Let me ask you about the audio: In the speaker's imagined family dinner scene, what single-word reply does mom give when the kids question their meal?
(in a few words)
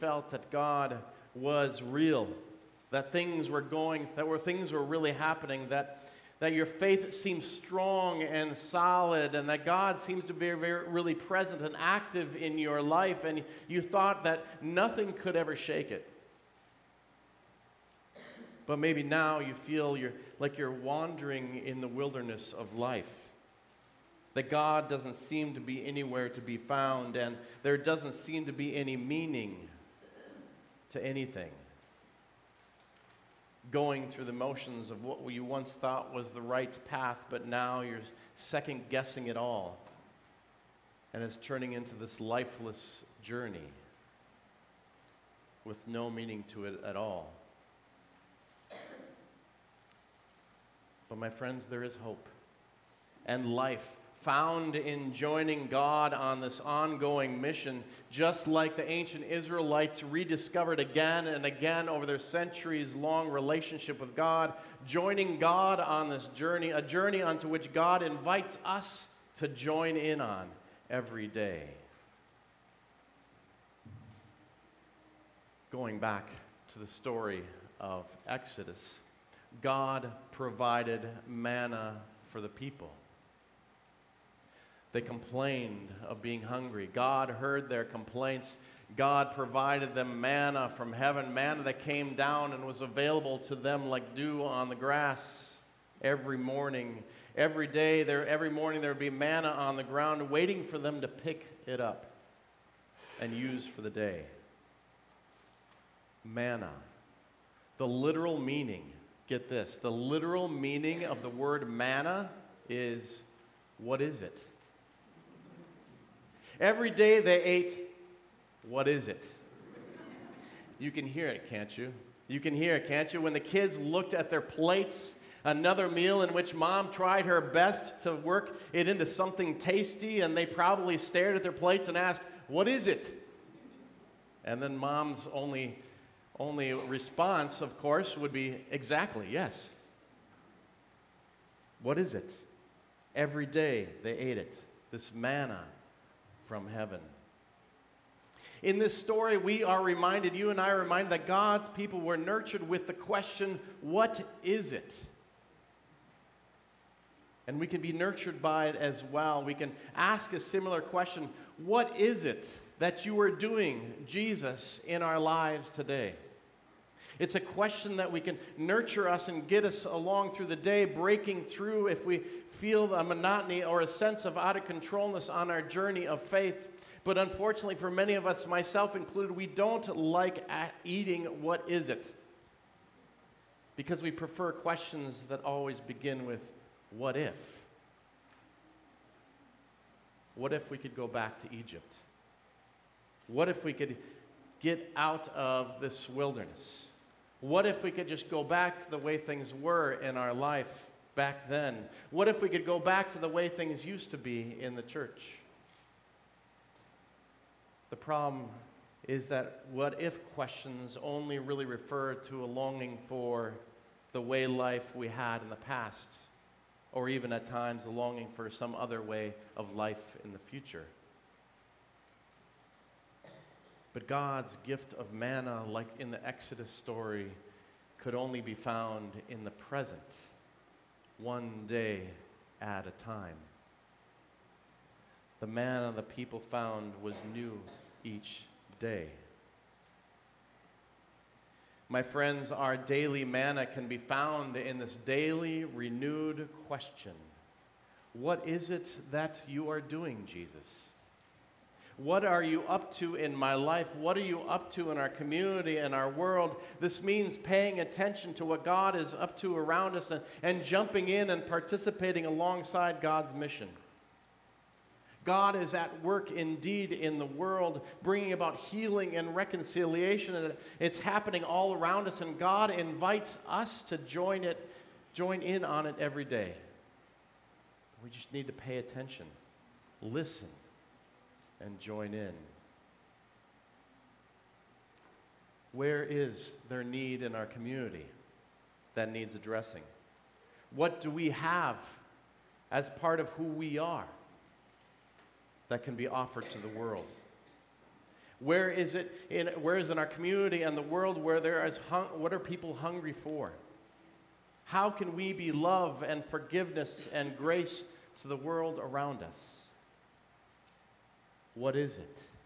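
Exactly.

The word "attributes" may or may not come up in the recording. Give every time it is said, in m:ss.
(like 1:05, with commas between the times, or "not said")
not said.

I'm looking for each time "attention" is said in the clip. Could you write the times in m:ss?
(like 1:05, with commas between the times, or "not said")
4:17, 4:38.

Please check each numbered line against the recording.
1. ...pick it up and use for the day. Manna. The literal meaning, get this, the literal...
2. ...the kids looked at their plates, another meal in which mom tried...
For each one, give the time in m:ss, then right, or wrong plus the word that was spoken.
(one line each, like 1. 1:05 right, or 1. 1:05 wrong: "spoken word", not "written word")
1. 1:41 right
2. 2:03 right.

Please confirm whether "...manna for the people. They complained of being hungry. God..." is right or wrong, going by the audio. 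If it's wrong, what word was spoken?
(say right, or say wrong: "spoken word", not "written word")
right.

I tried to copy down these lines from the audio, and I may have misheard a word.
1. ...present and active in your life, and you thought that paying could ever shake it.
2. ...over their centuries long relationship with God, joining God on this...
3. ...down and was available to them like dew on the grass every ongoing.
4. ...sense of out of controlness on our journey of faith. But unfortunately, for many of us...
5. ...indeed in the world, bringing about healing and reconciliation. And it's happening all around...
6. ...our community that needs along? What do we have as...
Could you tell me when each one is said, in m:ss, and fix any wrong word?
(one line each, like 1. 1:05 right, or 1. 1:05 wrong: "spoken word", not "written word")
1. 0:11 wrong: "nothing", not "paying"
2. 1:01 right
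3. 1:32 wrong: "morning", not "ongoing"
4. 2:53 right
5. 4:26 right
6. 4:47 wrong: "addressing", not "along".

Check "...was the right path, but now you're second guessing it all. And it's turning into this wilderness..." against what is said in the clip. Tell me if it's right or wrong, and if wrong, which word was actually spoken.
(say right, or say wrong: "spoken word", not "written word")
wrong: "lifeless", not "wilderness".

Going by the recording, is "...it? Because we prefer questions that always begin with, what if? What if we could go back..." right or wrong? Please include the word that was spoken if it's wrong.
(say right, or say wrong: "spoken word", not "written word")
right.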